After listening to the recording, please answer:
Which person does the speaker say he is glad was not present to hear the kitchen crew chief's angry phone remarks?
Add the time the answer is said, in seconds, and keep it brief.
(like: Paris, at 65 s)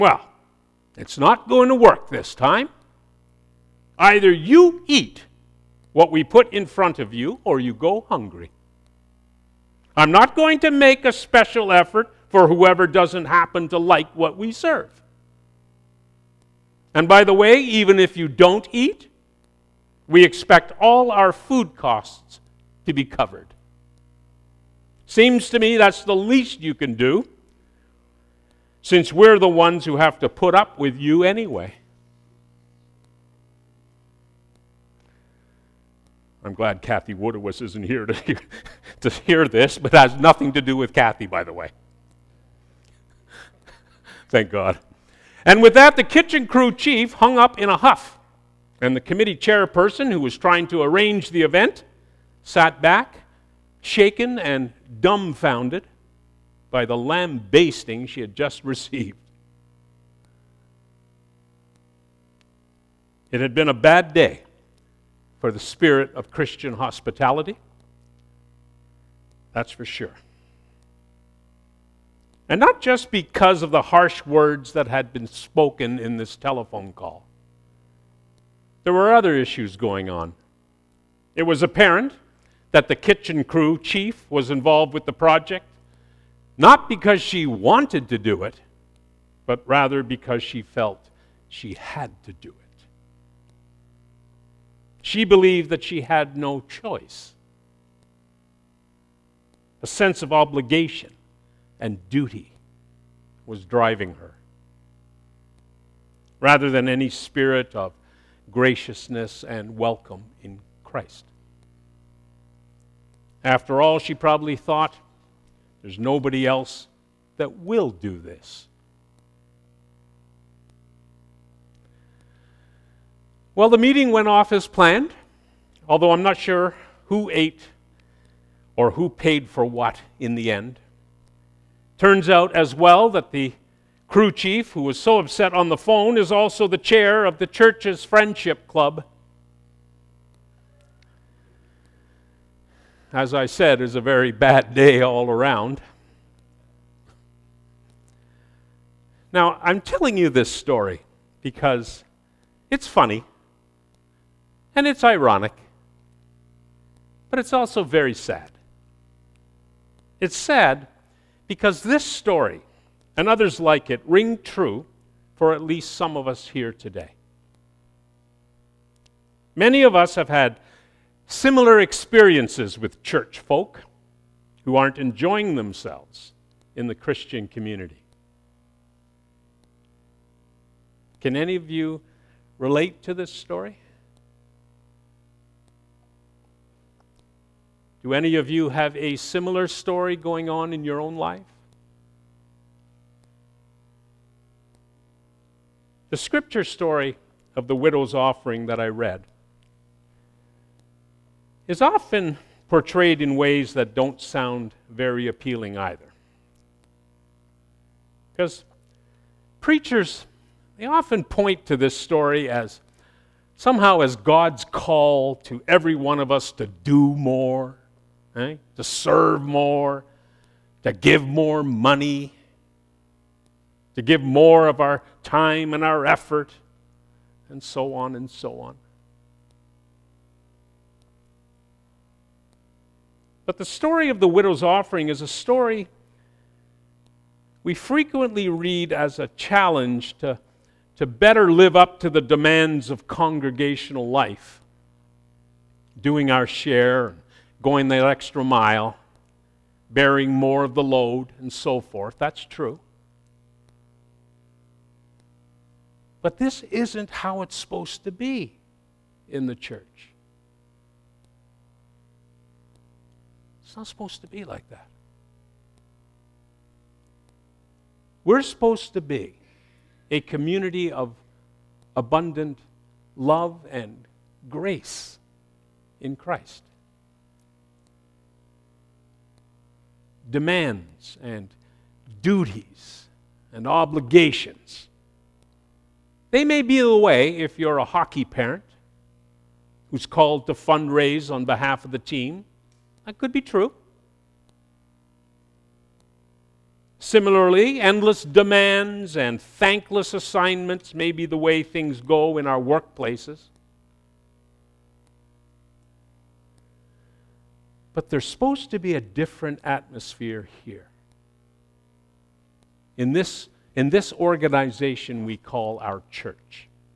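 Kathy Wooderwis, at 36 s.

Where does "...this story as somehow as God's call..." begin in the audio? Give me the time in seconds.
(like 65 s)
211 s.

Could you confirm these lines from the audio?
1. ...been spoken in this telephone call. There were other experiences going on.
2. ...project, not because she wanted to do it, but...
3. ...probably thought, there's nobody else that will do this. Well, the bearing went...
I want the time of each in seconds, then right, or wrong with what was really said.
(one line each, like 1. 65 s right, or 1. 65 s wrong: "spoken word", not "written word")
1. 75 s wrong: "issues", not "experiences"
2. 85 s right
3. 114 s wrong: "meeting", not "bearing".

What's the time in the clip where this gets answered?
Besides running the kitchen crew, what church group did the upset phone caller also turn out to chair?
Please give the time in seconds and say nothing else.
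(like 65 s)
138 s.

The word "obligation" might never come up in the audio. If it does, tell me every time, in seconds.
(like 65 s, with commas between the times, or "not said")
100 s, 283 s.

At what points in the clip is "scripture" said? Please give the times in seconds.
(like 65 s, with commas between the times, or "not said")
196 s.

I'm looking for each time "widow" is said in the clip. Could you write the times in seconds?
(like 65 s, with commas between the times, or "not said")
197 s, 234 s.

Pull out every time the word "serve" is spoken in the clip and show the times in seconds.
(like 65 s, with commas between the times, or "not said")
14 s, 218 s.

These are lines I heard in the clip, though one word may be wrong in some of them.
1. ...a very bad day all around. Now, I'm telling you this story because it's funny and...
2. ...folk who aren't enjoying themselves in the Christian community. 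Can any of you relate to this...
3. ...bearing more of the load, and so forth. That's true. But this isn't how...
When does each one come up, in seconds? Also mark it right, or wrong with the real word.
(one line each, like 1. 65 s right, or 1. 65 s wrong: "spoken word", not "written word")
1. 143 s right
2. 173 s right
3. 249 s right.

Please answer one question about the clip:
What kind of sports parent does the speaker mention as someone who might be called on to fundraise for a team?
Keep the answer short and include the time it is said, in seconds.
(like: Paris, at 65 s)
hockey parent, at 287 s.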